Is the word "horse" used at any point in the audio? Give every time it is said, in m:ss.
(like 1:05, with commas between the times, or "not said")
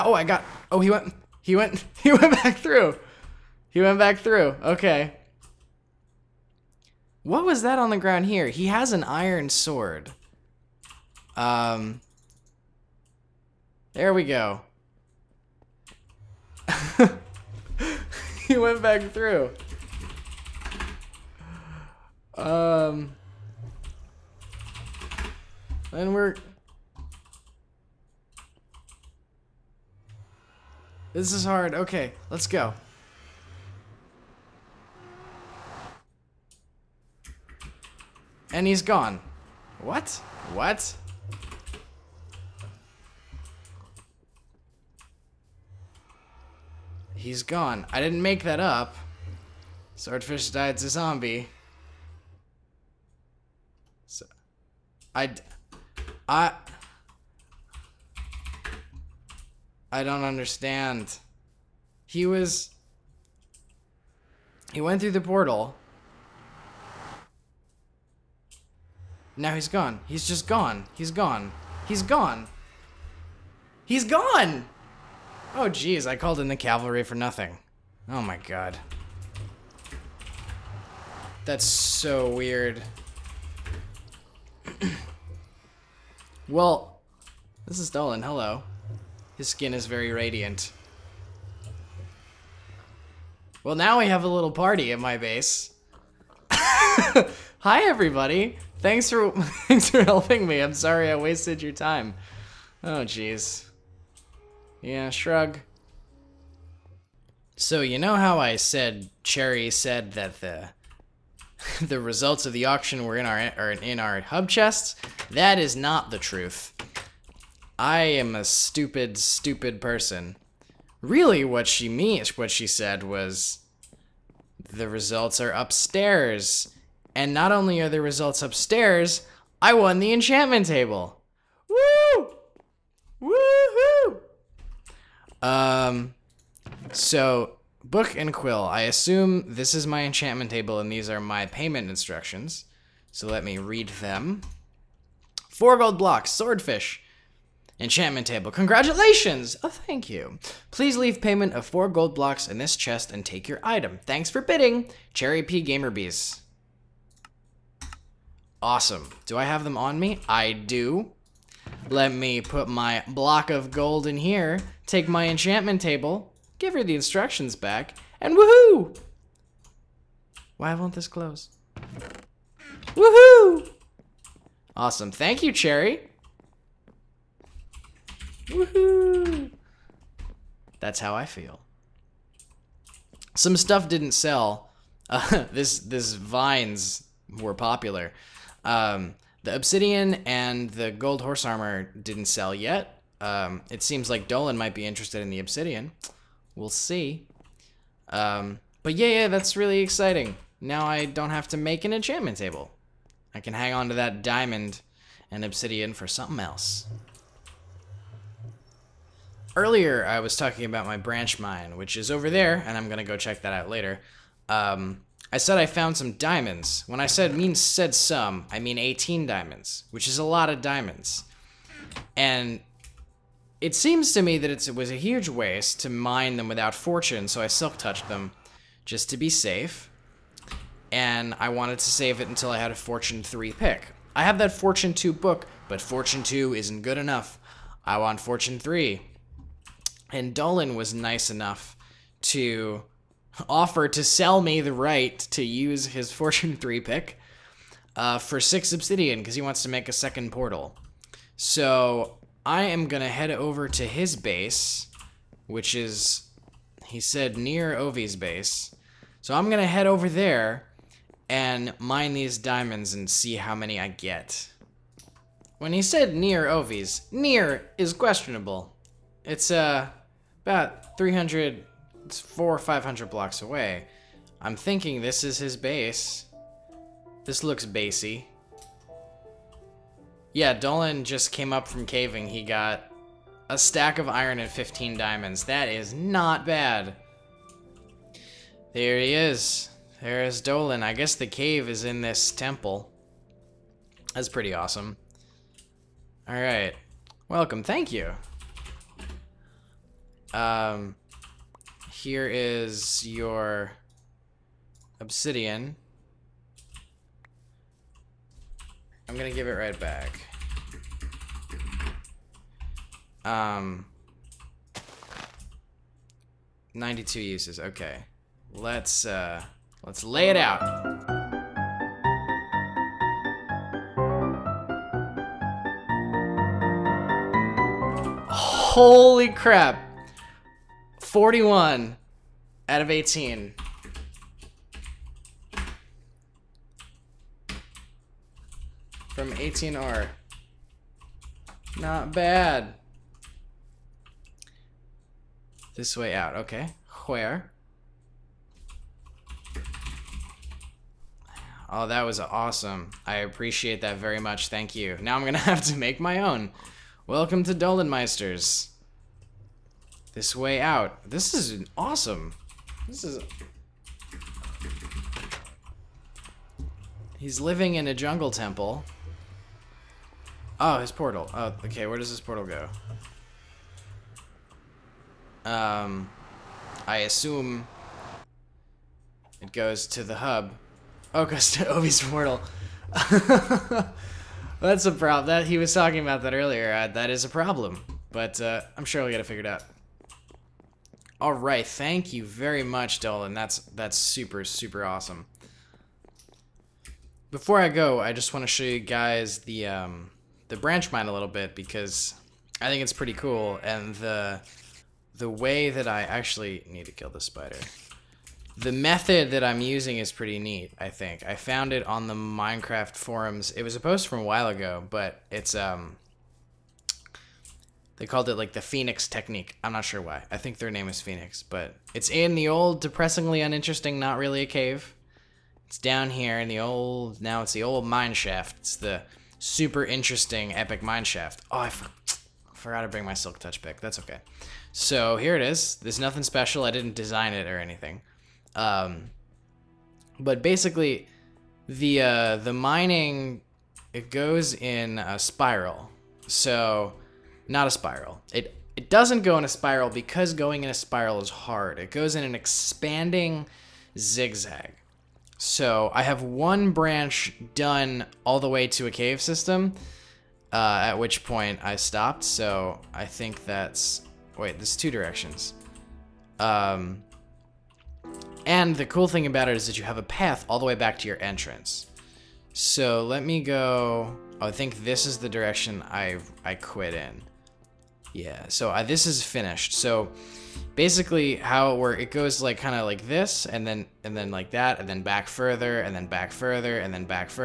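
3:11.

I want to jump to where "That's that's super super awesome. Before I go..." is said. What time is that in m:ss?
6:33.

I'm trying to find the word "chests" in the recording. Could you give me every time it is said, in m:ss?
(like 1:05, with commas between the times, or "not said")
1:54, 2:32.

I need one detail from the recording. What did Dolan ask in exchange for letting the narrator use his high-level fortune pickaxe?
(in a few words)
6 obsidian.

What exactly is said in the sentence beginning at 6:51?
I found it on the Minecraft forums.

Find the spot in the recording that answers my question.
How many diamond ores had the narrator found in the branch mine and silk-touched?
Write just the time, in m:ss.
3:38.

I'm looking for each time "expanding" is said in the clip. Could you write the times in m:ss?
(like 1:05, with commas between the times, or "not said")
7:32.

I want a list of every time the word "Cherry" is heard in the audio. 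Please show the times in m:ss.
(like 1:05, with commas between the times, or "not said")
1:49, 2:35, 2:55.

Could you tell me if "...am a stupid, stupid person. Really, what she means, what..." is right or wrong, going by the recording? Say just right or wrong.
right.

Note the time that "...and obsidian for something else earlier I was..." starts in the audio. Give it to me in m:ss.
3:25.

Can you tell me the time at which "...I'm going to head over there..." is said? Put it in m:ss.
4:19.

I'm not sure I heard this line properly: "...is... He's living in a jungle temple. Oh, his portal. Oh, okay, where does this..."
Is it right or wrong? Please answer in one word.
right.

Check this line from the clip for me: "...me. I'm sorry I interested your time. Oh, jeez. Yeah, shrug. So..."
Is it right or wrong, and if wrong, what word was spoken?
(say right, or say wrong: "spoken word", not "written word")
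wrong: "wasted", not "interested".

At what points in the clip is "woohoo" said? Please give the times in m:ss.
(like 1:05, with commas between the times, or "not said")
2:13, 2:48, 2:52, 2:58.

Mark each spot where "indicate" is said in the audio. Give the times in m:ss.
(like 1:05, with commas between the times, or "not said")
not said.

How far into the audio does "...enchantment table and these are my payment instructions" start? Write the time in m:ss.
2:20.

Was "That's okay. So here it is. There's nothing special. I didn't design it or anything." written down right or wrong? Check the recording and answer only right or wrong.
right.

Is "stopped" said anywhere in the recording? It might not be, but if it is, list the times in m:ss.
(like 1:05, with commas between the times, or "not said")
7:41.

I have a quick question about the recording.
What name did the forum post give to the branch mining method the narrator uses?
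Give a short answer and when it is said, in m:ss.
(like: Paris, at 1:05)
Phoenix technique, at 6:58.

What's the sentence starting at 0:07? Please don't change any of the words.
What was that on the ground here?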